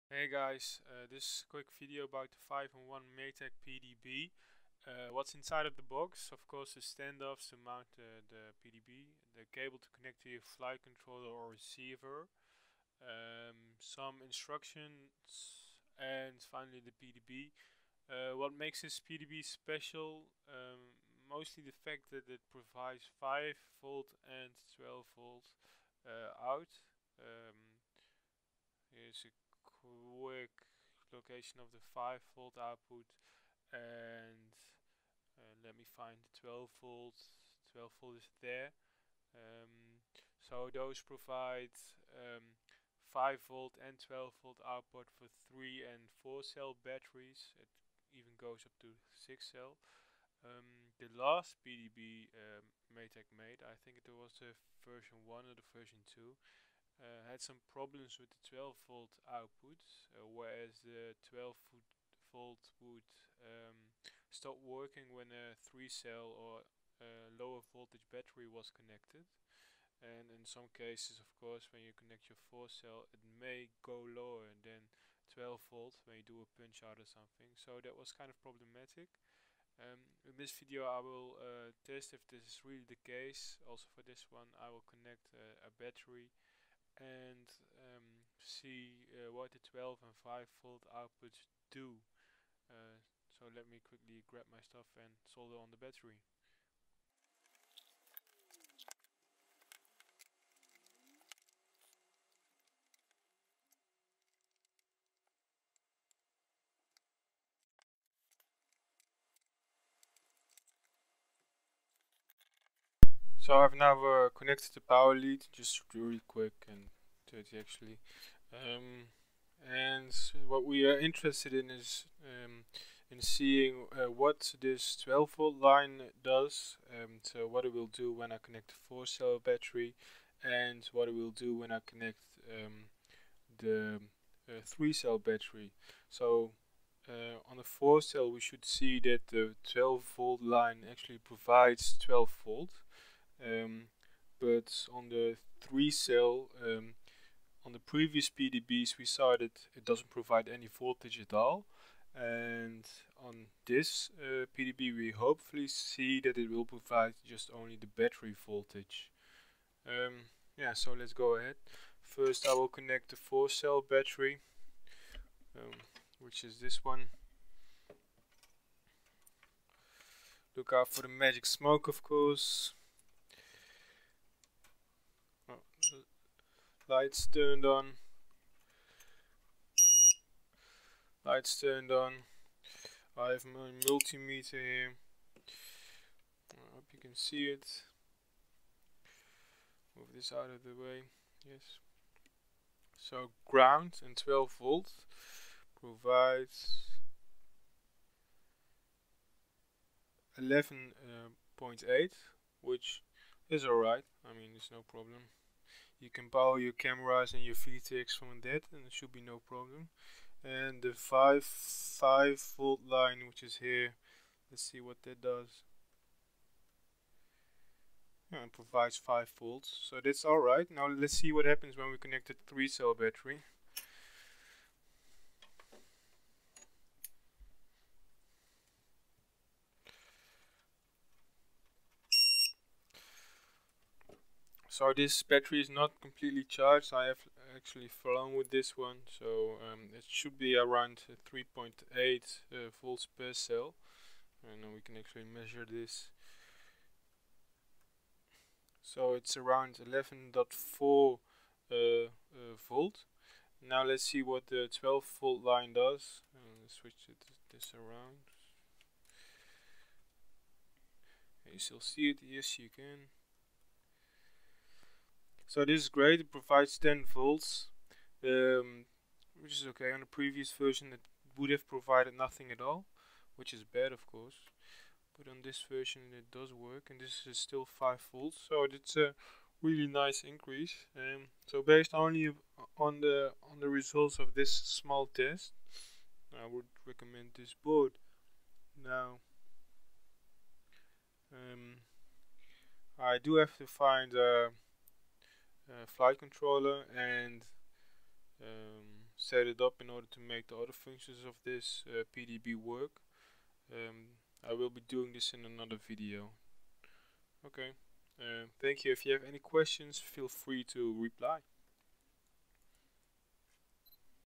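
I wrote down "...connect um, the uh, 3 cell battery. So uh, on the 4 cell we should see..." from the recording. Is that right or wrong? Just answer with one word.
right.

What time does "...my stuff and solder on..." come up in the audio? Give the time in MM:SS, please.
01:34.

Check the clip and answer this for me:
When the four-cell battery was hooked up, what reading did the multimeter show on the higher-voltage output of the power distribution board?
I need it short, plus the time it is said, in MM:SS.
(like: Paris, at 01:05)
11.8, at 03:20.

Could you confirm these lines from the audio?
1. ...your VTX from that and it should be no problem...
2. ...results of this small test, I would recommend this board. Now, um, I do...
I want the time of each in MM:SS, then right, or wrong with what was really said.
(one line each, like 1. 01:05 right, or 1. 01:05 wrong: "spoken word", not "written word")
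1. 03:27 right
2. 04:43 right.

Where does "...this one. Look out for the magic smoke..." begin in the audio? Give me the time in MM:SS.
02:46.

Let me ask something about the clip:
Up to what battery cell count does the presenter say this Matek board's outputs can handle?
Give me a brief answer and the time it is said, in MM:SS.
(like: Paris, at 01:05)
6 cell, at 00:49.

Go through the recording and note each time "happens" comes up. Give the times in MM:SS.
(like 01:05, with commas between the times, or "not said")
03:41.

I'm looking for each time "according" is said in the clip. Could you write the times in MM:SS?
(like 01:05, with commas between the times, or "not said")
not said.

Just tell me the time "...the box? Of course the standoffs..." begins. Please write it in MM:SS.
00:05.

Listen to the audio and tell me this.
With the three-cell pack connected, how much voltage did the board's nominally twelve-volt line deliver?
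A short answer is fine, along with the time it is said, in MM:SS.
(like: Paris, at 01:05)
10 volts, at 04:26.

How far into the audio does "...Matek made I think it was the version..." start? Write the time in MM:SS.
00:52.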